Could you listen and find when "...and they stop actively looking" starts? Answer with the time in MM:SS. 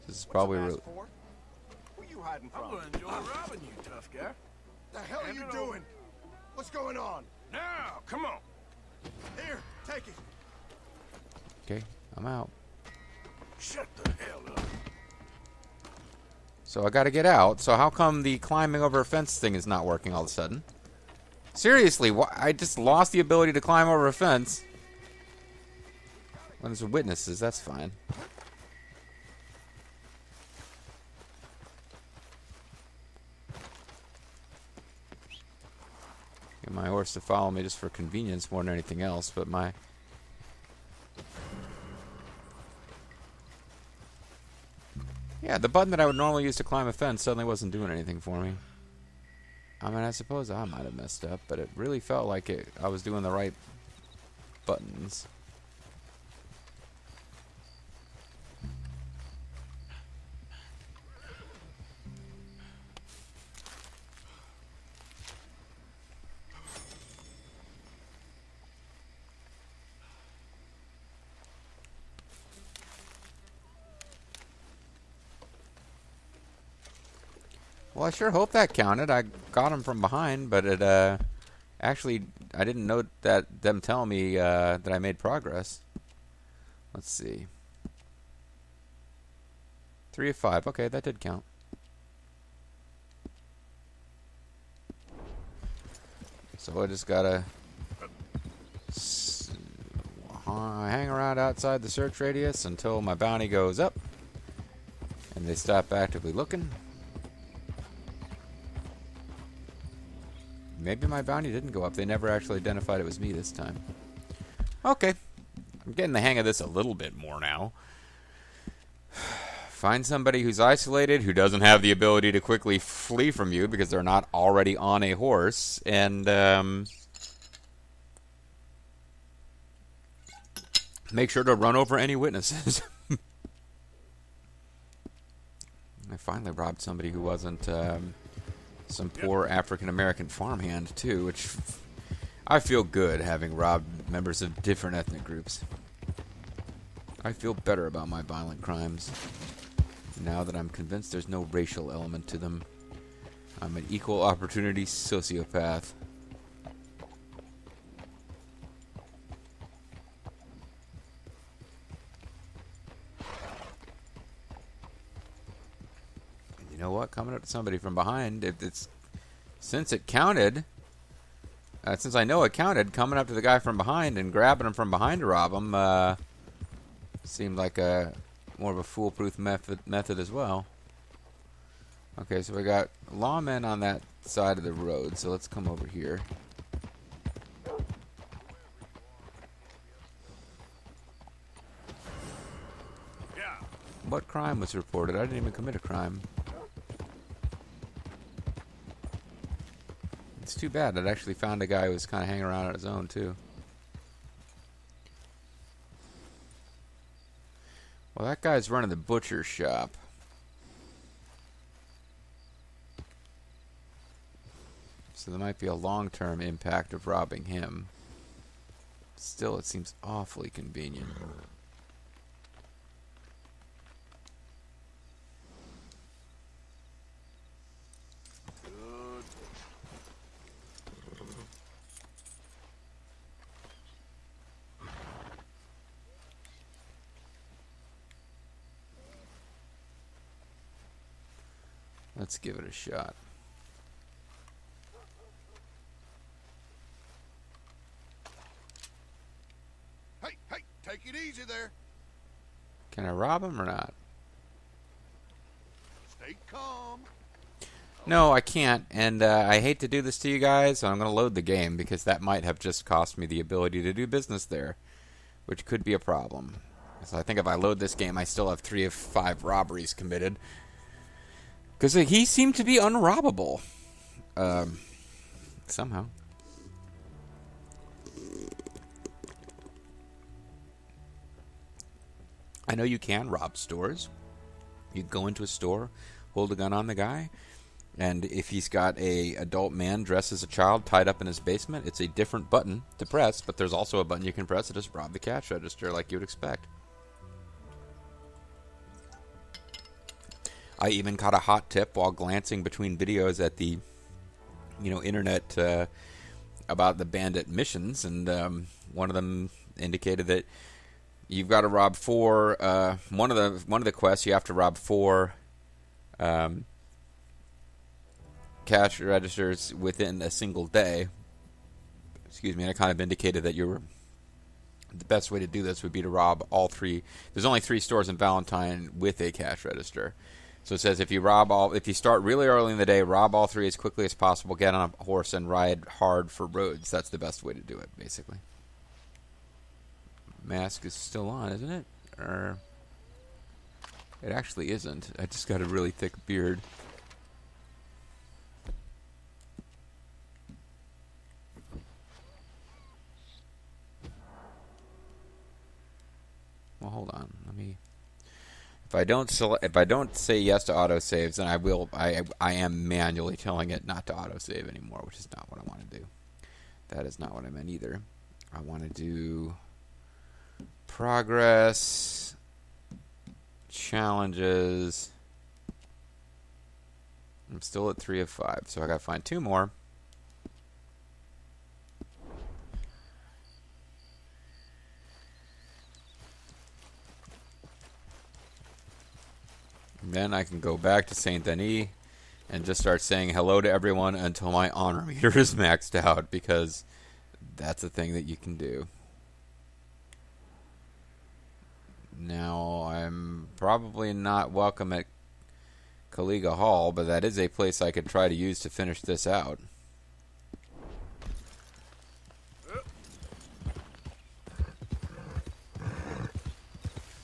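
01:45.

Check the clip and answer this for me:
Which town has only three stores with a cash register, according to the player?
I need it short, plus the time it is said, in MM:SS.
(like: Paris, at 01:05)
Valentine, at 05:28.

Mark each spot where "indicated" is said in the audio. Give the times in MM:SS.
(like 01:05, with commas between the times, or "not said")
05:09, 05:22.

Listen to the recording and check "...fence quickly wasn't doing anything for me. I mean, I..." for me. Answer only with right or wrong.
wrong.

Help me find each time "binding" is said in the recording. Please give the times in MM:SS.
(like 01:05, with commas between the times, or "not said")
not said.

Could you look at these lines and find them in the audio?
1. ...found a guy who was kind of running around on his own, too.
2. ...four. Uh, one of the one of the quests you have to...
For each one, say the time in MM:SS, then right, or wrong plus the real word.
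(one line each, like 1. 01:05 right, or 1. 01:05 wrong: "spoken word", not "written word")
1. 03:21 wrong: "hanging", not "running"
2. 05:11 right.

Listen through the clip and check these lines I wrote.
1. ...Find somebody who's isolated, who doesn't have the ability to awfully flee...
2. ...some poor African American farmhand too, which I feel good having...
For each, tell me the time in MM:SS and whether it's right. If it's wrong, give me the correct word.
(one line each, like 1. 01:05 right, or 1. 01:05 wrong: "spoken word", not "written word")
1. 01:59 wrong: "quickly", not "awfully"
2. 02:18 right.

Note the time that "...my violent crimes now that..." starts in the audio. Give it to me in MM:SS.
02:28.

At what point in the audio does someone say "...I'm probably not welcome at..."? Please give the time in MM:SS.
06:42.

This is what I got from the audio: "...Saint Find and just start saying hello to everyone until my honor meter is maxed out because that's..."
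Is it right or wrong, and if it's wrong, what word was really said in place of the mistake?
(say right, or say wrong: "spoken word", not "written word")
wrong: "Denis", not "Find".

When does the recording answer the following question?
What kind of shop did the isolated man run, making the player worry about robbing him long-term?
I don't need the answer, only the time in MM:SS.
03:28.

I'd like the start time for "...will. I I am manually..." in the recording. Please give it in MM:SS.
06:01.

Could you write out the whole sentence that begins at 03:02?
Okay, so we got lawmen on that side of the road, so let's come over here.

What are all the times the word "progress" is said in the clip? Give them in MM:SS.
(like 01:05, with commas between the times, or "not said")
01:25, 06:10.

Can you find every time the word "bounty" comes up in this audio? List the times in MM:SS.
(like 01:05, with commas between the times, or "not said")
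01:43, 01:51.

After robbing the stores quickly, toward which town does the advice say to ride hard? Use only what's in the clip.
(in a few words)
Rhodes.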